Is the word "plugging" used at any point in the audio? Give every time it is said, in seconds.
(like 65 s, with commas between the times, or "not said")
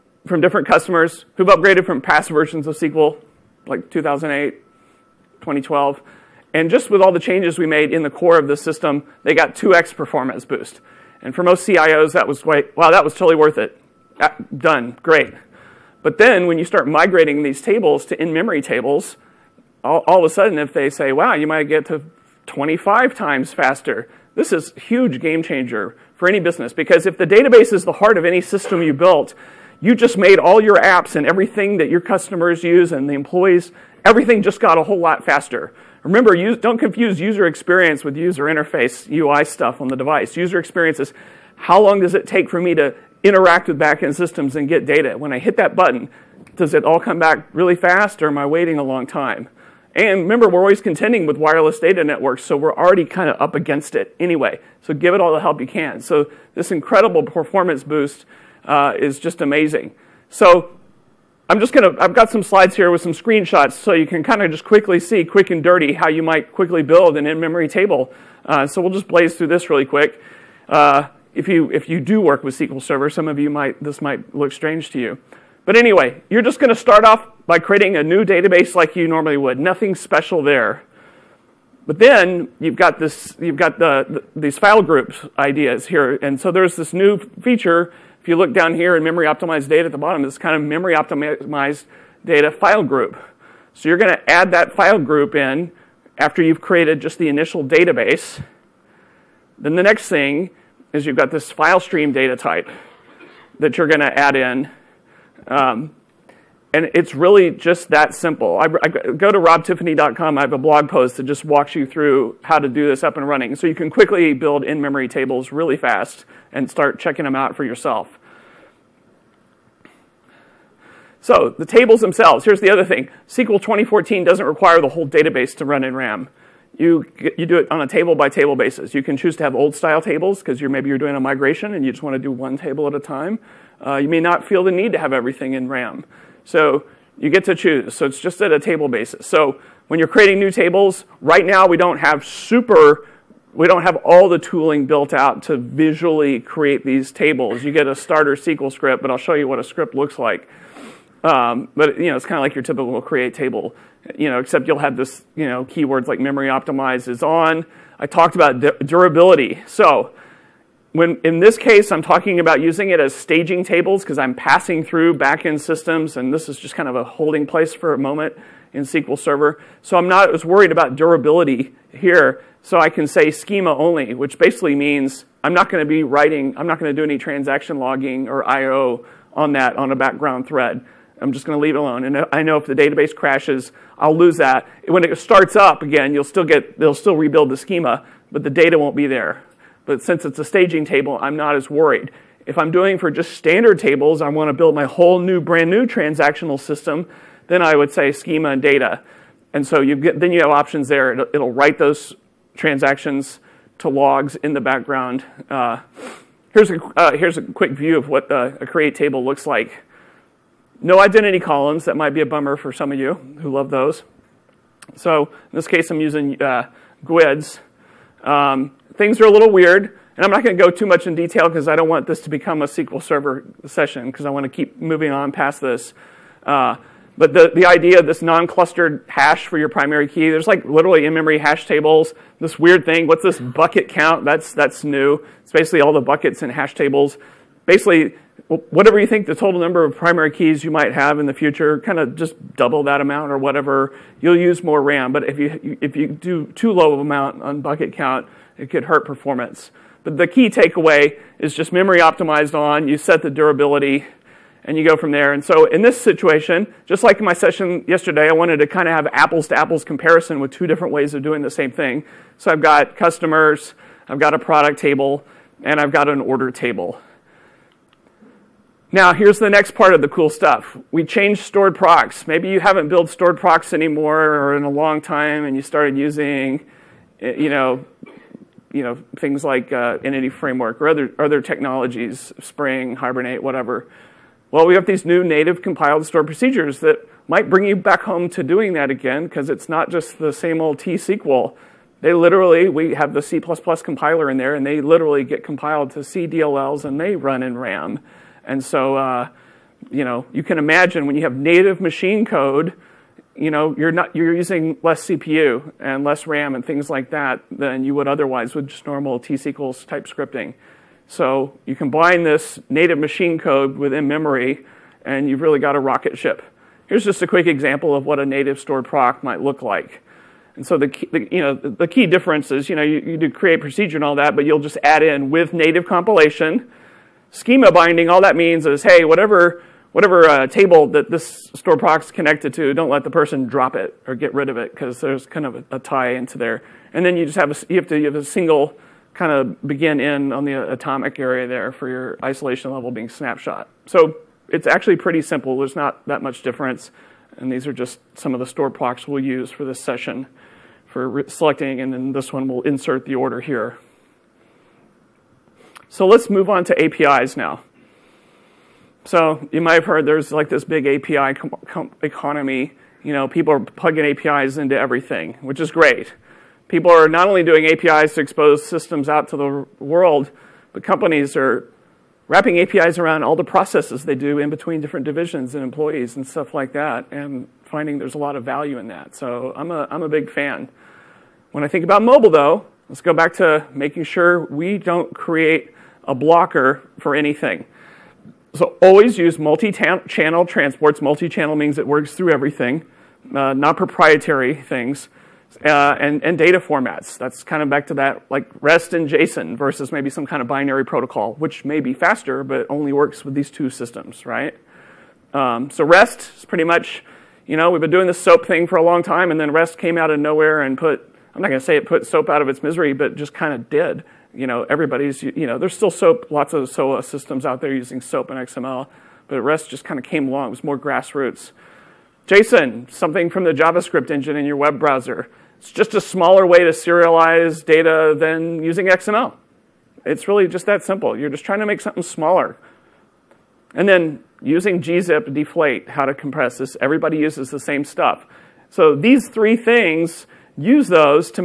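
363 s.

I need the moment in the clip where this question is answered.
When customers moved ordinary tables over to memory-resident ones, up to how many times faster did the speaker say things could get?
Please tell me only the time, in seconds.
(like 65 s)
22 s.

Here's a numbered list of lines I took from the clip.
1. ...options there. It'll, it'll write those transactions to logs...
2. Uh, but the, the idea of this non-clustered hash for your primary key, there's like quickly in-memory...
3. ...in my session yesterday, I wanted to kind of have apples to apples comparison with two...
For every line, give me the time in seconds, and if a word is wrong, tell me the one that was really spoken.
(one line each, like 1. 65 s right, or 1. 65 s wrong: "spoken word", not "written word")
1. 200 s right
2. 226 s wrong: "literally", not "quickly"
3. 257 s right.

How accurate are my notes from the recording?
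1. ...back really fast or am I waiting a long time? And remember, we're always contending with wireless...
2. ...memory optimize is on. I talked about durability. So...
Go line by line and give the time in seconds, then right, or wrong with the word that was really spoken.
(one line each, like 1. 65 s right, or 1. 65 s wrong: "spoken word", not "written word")
1. 47 s right
2. 156 s right.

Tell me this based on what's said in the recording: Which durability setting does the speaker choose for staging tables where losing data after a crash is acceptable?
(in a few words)
schema only.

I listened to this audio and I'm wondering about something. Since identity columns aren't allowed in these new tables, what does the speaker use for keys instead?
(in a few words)
GUIDs.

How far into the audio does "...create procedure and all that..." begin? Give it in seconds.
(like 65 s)
323 s.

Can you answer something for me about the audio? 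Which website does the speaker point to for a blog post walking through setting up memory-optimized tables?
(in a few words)
robtiffany.com.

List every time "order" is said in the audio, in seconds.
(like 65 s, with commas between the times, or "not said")
266 s, 353 s.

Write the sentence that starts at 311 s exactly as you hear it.
So you combine this native machine code within memory, and you've really got a rocket ship.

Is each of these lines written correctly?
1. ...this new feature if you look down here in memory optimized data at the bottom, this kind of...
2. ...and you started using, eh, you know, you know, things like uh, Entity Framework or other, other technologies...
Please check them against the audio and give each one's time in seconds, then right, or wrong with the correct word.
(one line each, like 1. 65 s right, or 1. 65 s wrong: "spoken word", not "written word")
1. 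86 s right
2. 275 s right.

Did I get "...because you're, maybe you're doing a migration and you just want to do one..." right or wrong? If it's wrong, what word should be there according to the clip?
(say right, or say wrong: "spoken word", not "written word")
right.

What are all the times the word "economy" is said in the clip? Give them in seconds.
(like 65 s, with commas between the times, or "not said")
362 s.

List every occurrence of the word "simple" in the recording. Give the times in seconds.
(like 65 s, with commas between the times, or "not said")
108 s, 345 s, 430 s.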